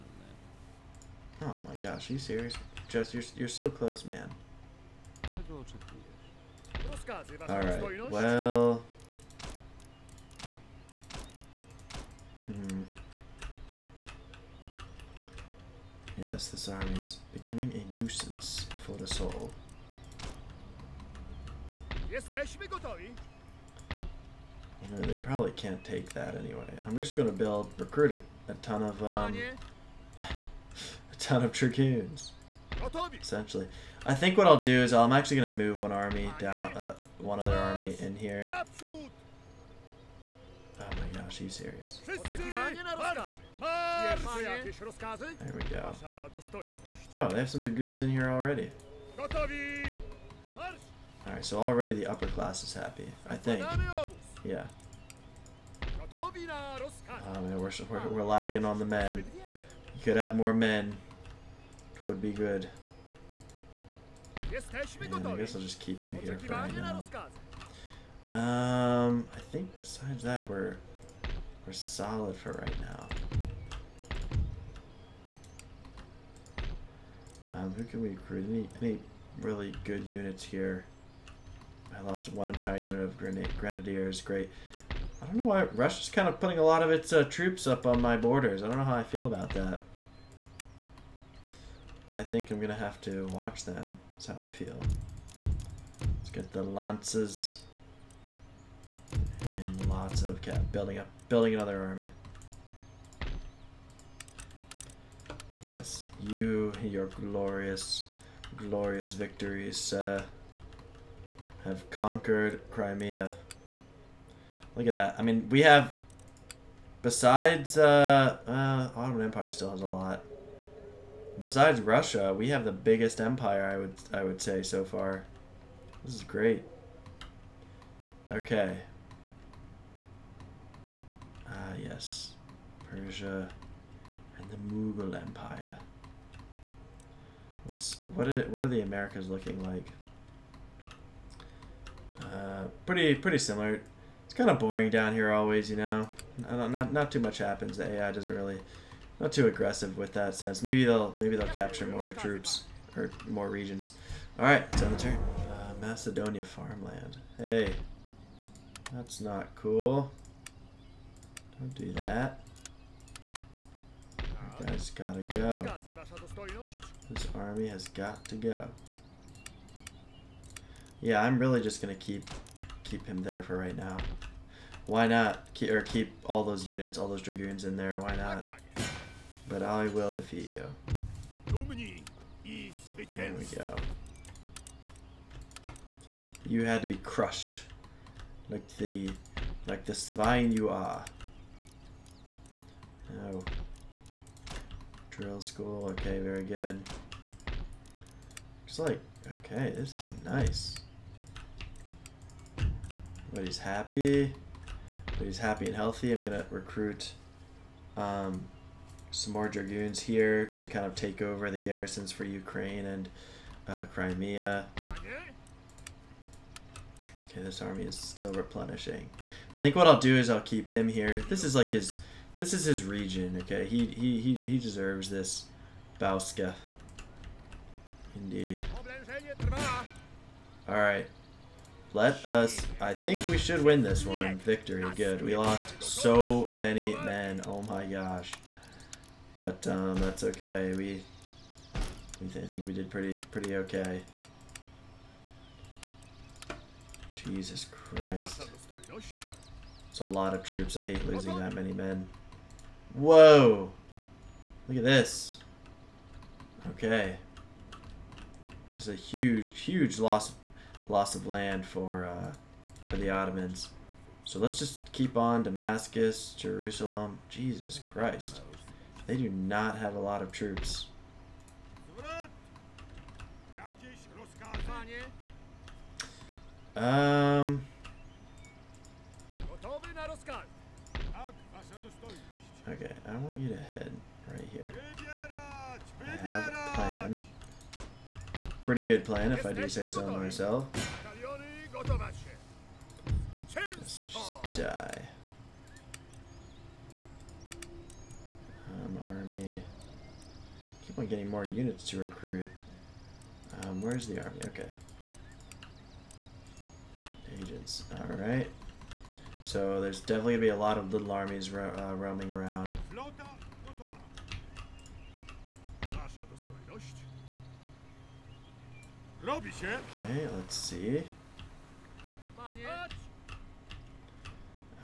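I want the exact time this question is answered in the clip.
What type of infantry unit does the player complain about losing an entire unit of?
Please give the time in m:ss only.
1:23.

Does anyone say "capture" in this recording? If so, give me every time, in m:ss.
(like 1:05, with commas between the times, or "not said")
2:31.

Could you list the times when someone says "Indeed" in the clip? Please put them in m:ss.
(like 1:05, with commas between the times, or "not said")
3:48.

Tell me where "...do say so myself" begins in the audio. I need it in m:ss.
4:49.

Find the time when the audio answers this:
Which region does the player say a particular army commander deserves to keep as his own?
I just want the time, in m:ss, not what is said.
3:45.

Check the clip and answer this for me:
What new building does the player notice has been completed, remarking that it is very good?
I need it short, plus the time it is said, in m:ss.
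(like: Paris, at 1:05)
Drill school, at 3:15.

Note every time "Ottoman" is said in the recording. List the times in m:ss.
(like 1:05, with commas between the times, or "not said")
1:58, 4:23.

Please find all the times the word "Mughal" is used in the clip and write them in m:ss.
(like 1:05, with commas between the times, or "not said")
2:14.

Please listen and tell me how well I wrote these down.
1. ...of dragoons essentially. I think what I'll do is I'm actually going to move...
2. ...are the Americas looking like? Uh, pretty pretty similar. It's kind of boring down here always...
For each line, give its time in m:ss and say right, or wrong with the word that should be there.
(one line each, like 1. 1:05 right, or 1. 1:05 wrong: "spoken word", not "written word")
1. 0:31 right
2. 2:18 right.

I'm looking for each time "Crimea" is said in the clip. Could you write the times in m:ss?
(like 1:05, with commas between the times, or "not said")
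1:52, 3:33.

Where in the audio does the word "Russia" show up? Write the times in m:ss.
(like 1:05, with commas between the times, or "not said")
1:25, 2:01.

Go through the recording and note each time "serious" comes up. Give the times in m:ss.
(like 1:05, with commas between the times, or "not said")
0:02, 0:41.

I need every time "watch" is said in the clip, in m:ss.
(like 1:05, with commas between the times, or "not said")
1:33.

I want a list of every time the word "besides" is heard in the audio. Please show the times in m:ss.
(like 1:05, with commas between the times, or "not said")
1:09, 1:57, 2:01.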